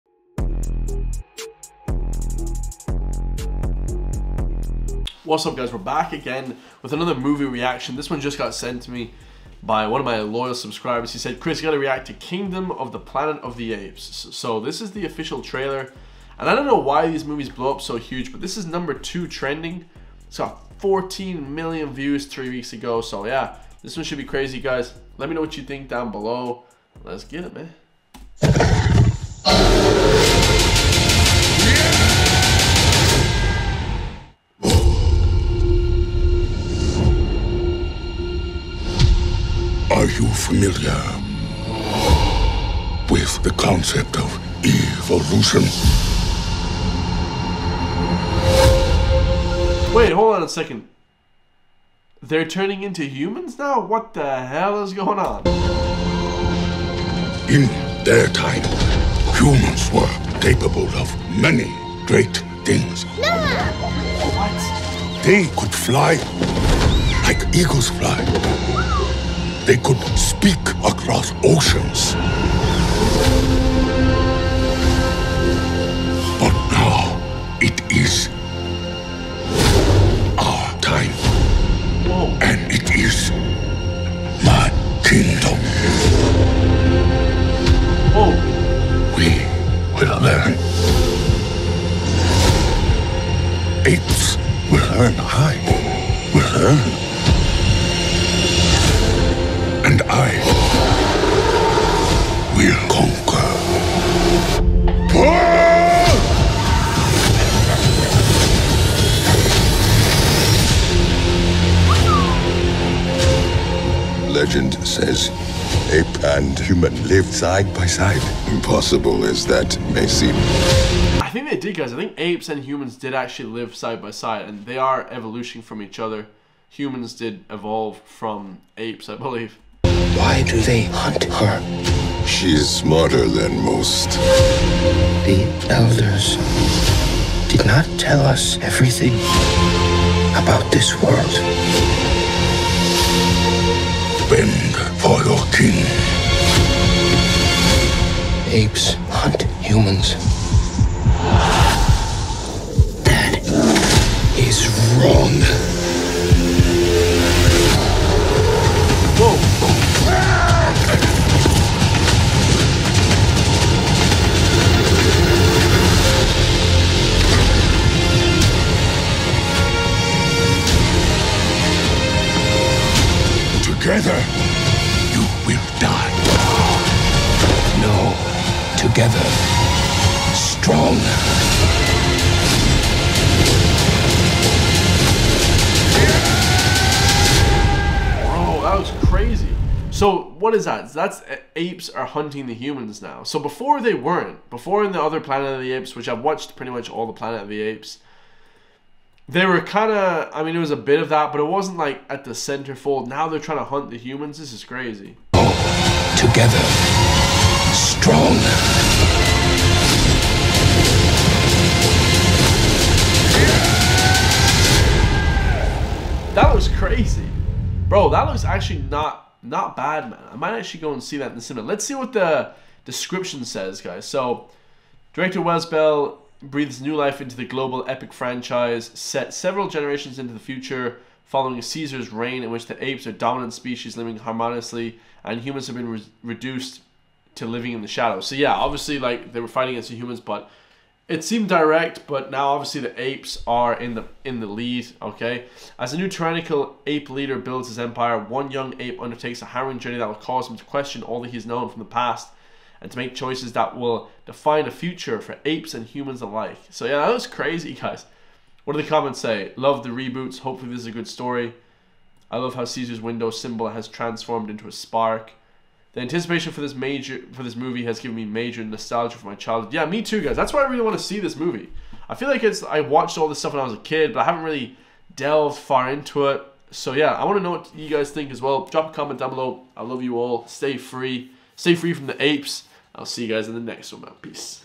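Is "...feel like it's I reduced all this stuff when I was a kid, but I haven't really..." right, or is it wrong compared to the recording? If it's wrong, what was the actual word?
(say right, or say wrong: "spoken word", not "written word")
wrong: "watched", not "reduced".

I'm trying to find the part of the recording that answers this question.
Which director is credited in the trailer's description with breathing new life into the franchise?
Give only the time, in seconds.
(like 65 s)
225 s.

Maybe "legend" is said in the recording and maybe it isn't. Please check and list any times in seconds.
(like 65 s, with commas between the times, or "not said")
114 s.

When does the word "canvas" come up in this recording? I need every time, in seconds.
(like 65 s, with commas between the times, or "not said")
not said.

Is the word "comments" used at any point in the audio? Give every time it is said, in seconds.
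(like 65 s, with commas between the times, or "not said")
258 s, 278 s.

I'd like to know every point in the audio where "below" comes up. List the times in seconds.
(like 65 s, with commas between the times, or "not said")
26 s, 279 s.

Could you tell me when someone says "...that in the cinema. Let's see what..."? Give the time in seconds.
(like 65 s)
221 s.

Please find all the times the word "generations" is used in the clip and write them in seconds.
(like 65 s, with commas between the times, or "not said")
229 s.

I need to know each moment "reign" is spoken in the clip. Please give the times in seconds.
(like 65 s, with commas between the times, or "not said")
232 s.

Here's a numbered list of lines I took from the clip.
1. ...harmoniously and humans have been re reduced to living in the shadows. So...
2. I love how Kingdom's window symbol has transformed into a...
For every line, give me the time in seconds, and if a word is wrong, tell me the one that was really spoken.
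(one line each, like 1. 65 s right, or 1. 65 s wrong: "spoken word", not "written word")
1. 234 s right
2. 262 s wrong: "Caesar", not "Kingdom".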